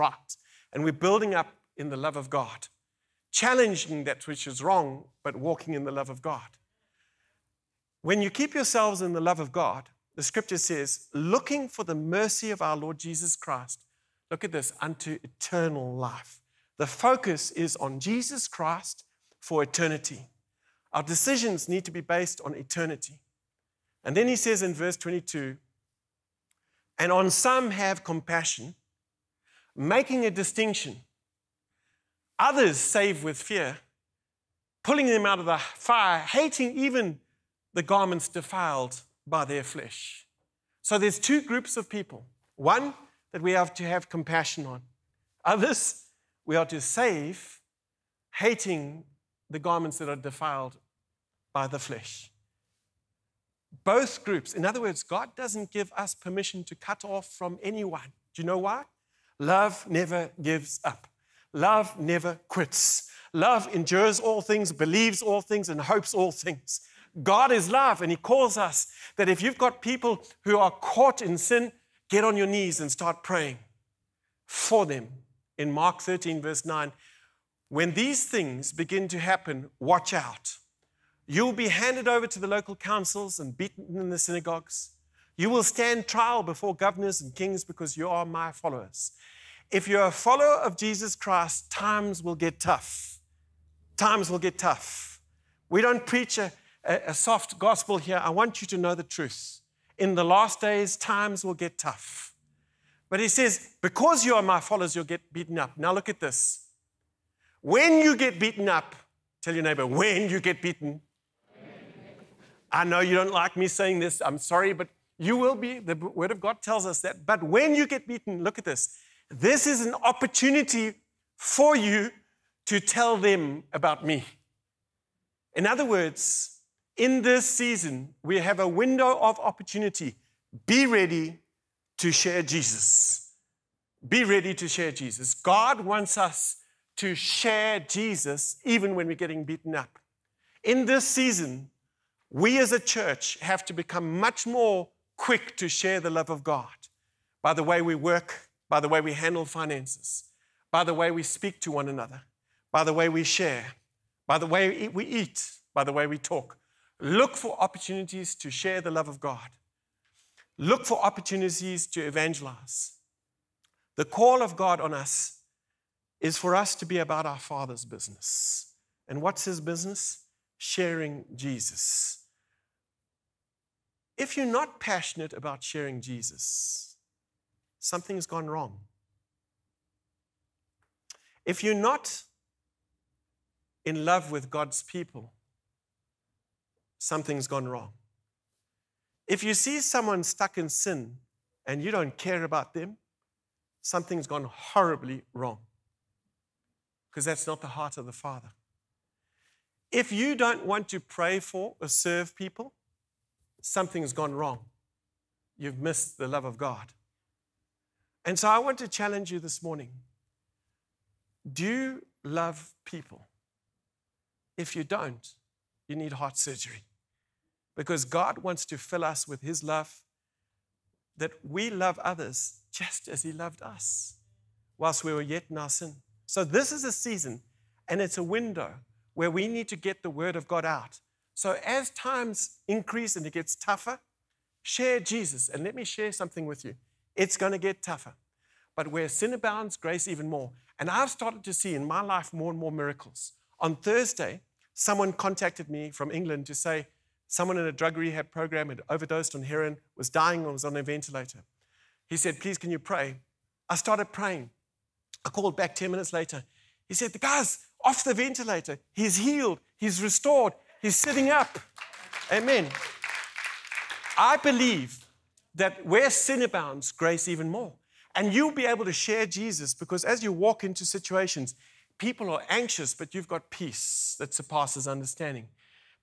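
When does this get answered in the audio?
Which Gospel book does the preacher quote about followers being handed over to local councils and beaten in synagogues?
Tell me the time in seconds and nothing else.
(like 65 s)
75 s.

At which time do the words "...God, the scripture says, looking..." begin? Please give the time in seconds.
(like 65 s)
9 s.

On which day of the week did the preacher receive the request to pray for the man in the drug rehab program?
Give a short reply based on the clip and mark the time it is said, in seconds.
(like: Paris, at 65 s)
Thursday, at 243 s.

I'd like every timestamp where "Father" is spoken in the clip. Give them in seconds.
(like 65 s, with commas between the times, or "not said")
167 s, 198 s.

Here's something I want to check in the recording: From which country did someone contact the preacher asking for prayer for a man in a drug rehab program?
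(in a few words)
England.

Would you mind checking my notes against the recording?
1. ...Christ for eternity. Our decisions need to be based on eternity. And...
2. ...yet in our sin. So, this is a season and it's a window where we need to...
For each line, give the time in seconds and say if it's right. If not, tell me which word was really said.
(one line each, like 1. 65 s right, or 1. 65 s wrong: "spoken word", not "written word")
1. 18 s right
2. 225 s right.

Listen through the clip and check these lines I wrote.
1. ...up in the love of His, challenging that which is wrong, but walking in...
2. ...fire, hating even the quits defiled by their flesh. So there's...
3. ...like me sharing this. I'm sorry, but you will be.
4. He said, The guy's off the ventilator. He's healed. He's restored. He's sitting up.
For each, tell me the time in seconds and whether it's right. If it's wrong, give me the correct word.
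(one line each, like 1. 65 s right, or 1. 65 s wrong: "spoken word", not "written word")
1. 1 s wrong: "God", not "His"
2. 35 s wrong: "garments", not "quits"
3. 113 s wrong: "saying", not "sharing"
4. 256 s right.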